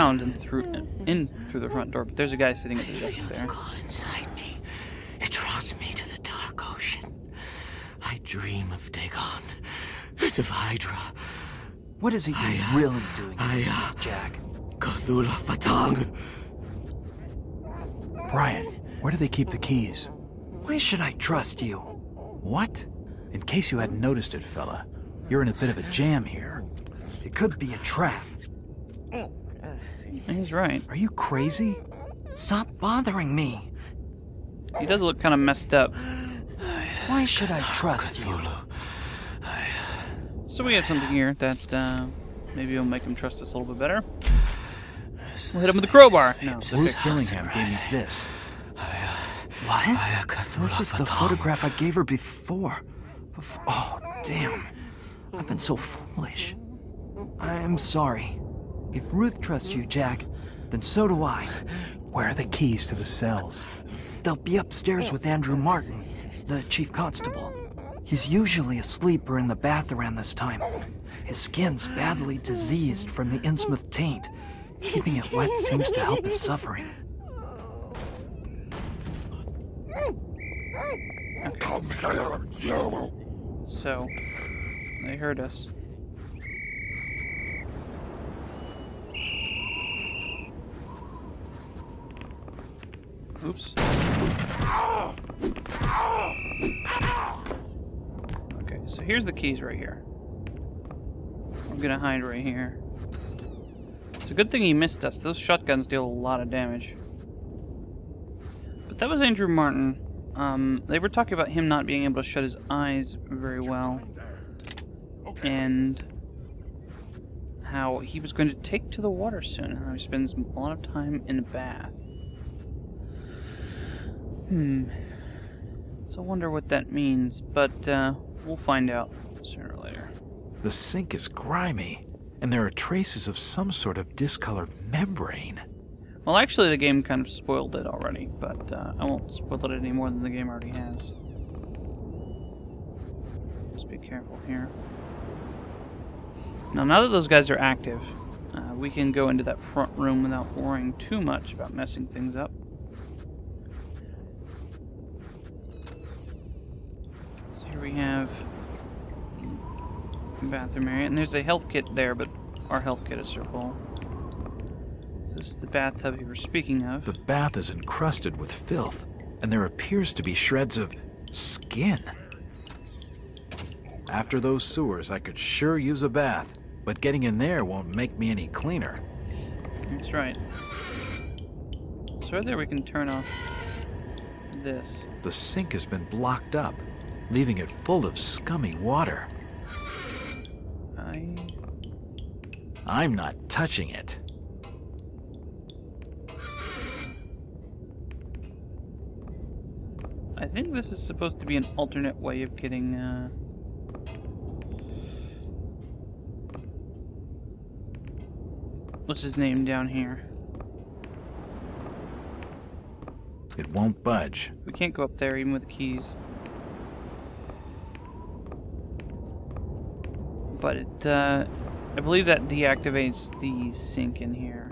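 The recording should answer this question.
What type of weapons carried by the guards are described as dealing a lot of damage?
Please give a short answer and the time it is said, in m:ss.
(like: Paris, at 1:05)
Shotguns, at 1:45.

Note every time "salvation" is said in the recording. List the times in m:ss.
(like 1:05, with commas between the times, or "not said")
not said.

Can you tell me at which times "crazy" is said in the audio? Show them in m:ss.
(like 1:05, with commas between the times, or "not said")
0:31.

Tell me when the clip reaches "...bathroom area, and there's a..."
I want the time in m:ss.
2:40.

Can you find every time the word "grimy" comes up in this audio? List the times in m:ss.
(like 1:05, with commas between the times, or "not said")
2:11.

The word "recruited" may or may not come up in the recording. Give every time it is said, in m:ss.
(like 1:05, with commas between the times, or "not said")
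not said.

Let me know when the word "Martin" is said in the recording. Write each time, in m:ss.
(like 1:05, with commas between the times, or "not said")
1:05, 1:49.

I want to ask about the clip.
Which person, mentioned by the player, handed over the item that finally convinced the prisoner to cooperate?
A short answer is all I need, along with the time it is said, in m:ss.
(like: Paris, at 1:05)
Bruce Killingham, at 0:46.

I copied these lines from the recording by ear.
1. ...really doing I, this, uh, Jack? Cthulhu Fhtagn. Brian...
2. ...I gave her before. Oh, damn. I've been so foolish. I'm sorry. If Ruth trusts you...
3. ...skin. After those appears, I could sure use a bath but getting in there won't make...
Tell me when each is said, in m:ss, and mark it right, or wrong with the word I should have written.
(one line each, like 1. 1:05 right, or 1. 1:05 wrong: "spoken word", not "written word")
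1. 0:12 right
2. 0:51 right
3. 2:51 wrong: "sewers", not "appears".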